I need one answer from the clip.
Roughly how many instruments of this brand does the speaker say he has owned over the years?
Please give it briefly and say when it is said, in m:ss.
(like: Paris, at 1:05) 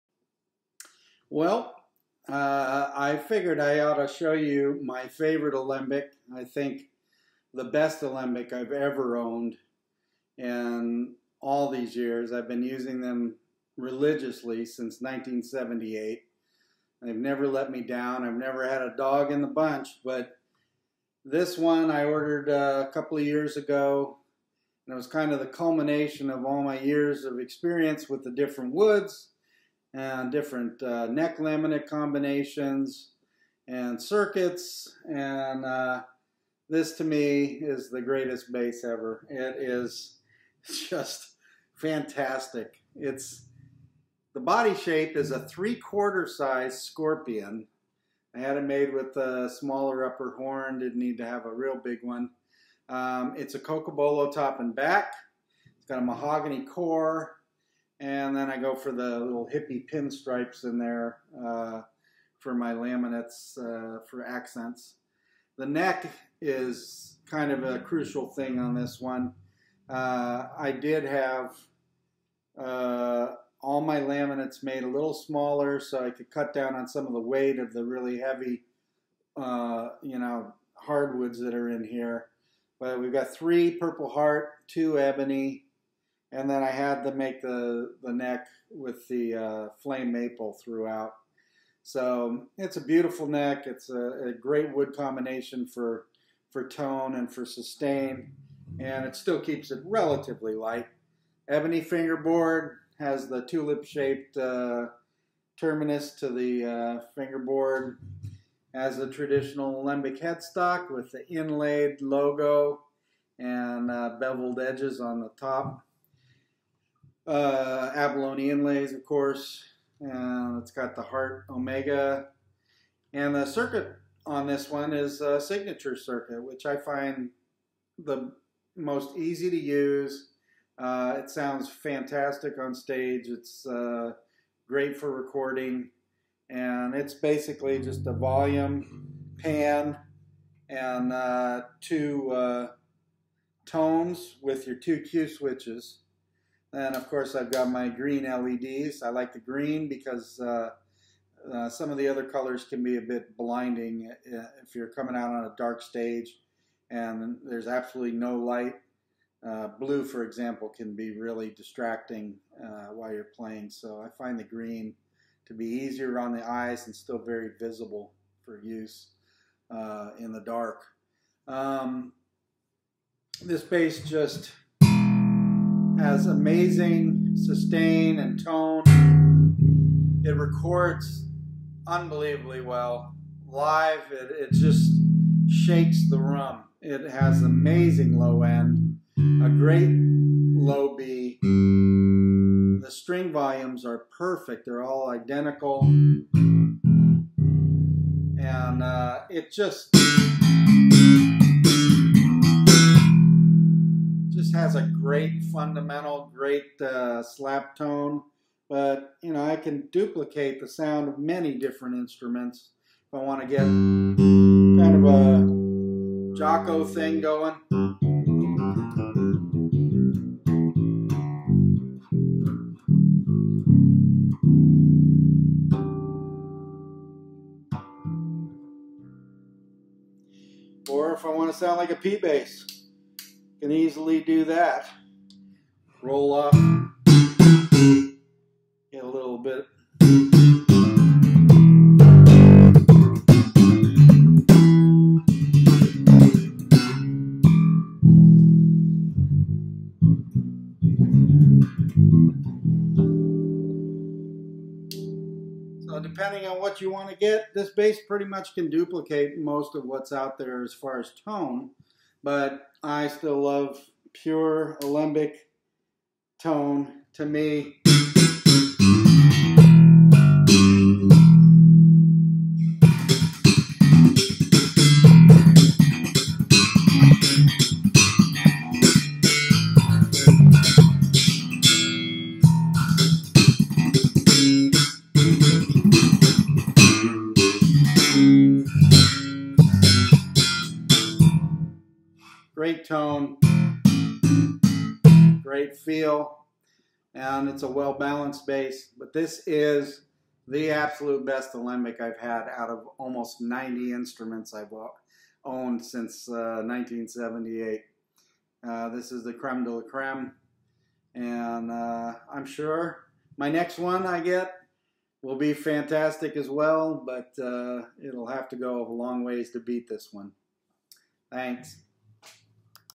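Almost 90, at 5:02.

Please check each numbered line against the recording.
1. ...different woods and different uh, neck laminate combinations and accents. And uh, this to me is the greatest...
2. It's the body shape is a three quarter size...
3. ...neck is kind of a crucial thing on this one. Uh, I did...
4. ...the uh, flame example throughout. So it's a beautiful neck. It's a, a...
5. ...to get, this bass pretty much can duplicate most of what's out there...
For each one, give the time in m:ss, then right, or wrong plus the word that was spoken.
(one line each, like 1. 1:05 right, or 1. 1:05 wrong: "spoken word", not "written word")
1. 0:28 wrong: "circuits", not "accents"
2. 0:42 right
3. 1:05 right
4. 1:29 wrong: "maple", not "example"
5. 4:17 right.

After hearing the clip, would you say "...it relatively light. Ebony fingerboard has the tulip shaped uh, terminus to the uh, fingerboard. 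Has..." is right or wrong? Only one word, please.
right.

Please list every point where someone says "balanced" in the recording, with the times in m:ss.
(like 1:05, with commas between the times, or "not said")
4:57.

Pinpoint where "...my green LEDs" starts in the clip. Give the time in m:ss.
2:27.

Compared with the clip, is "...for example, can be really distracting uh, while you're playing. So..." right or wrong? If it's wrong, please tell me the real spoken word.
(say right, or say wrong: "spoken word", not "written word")
right.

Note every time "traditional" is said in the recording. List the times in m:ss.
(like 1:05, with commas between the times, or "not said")
1:49.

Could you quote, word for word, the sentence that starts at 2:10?
Uh, it sounds fantastic on stage.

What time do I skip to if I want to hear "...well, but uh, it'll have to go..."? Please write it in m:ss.
5:16.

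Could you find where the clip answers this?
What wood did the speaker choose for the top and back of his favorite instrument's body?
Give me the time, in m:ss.
0:53.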